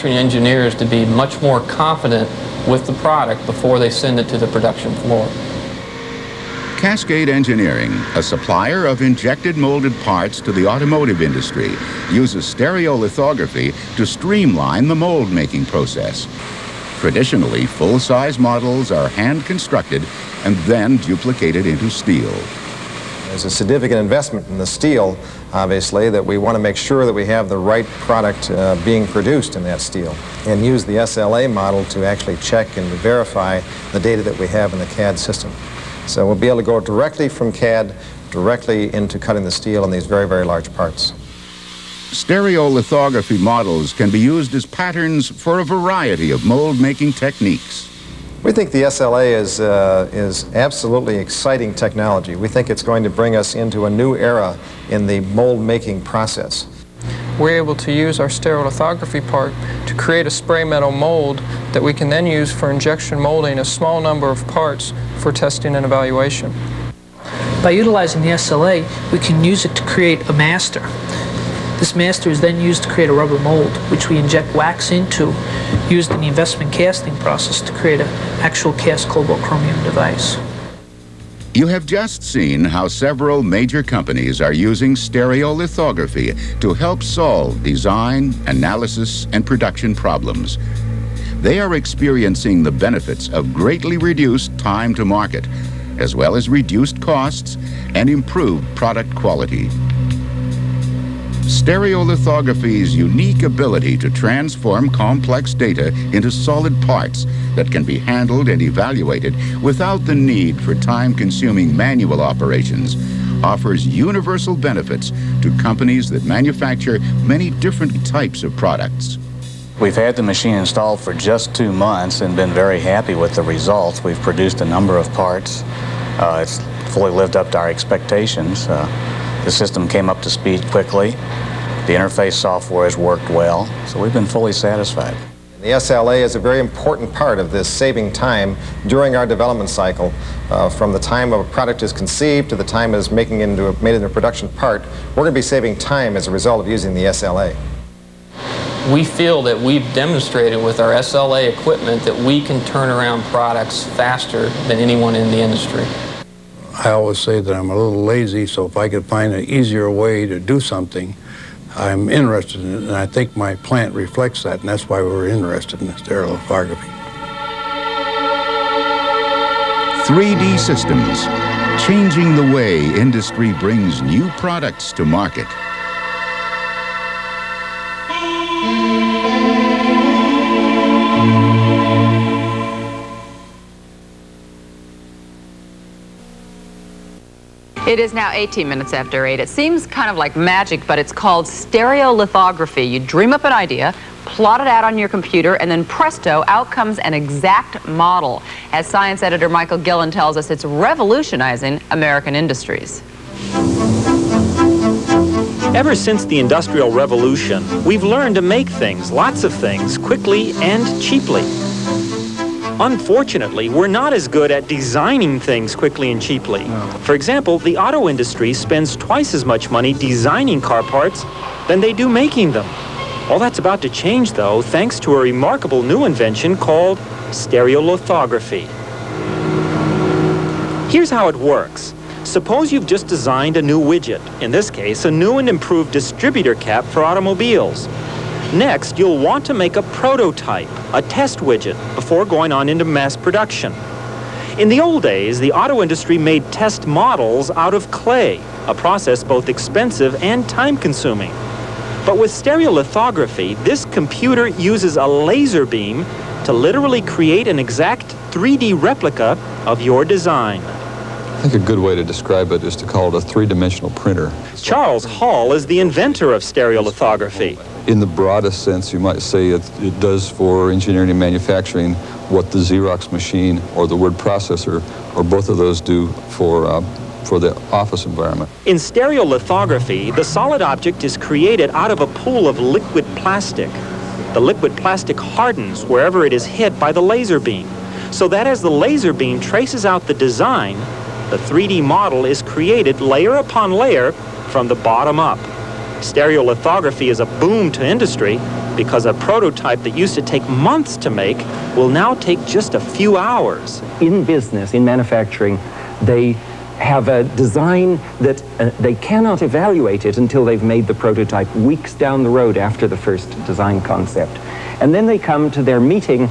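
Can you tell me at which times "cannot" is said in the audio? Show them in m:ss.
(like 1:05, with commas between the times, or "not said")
5:08.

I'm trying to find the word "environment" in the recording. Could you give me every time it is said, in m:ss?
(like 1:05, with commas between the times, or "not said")
4:38.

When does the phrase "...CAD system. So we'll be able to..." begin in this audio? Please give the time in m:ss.
0:34.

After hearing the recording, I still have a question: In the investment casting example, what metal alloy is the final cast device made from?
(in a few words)
cobalt chromium.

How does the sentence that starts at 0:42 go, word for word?
Stereolithography models can be used as patterns for a variety of mold-making techniques.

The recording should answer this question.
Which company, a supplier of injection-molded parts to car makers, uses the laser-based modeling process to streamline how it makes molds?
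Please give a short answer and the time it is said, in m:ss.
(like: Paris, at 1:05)
Cascade Engineering, at 0:06.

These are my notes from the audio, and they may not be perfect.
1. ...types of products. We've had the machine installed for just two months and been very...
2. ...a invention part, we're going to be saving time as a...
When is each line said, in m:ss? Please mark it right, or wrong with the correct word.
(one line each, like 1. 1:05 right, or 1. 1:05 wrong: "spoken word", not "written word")
1. 1:58 right
2. 2:24 wrong: "production", not "invention".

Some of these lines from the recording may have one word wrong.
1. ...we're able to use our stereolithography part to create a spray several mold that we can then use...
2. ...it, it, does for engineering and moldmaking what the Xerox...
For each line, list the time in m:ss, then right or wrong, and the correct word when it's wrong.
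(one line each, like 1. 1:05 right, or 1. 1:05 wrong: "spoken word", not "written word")
1. 0:57 wrong: "metal", not "several"
2. 4:29 wrong: "manufacturing", not "moldmaking".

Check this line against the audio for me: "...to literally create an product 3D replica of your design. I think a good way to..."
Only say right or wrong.
wrong.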